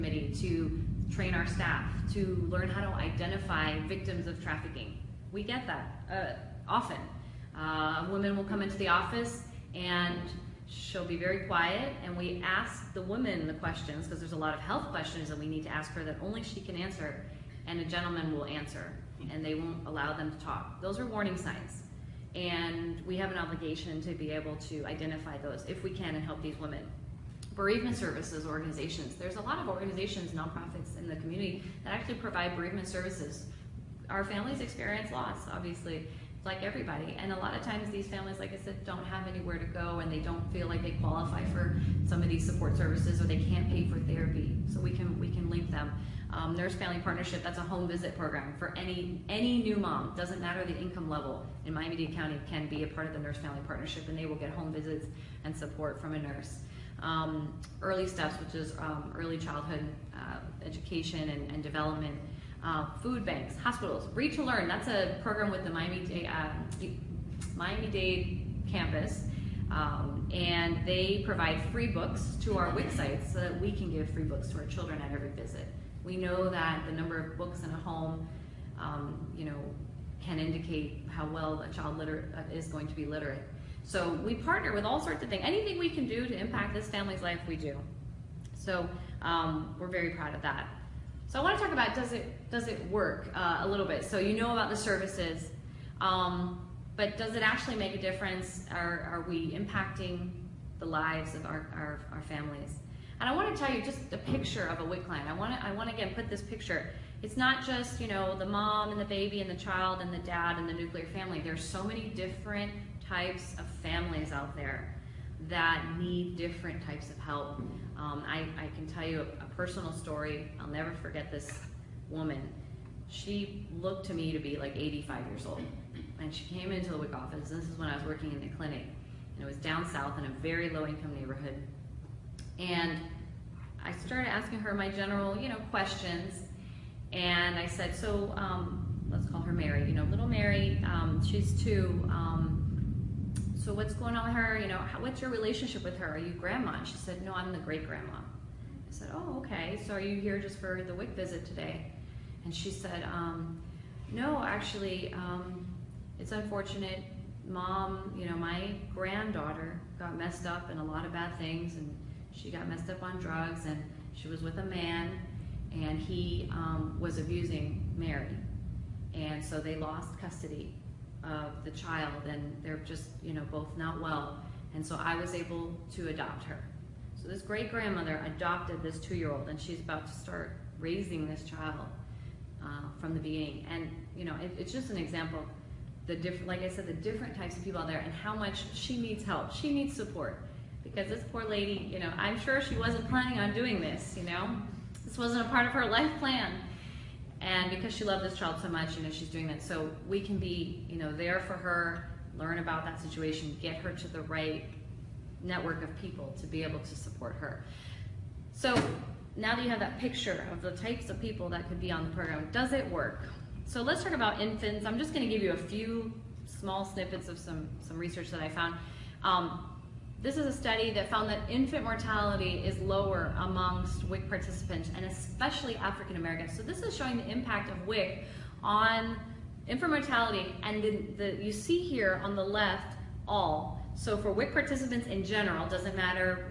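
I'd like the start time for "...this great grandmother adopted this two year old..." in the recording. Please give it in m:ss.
2:57.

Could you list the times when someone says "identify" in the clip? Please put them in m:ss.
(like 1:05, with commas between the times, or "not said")
0:02, 0:24.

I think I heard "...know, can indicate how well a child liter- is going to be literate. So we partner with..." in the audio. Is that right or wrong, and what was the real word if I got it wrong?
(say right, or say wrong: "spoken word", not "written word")
right.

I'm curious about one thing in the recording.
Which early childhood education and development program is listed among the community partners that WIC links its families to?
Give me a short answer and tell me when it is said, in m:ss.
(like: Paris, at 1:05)
Early Steps, at 0:57.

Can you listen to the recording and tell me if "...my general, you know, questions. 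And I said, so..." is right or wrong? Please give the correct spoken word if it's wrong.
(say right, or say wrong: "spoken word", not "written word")
right.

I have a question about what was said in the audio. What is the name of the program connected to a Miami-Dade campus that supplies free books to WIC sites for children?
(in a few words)
Read to Learn.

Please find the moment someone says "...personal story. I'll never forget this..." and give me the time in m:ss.
1:59.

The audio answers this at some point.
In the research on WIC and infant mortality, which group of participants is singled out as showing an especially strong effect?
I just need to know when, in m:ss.
3:45.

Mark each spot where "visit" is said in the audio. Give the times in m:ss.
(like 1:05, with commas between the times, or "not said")
0:47, 0:54, 1:15, 2:31.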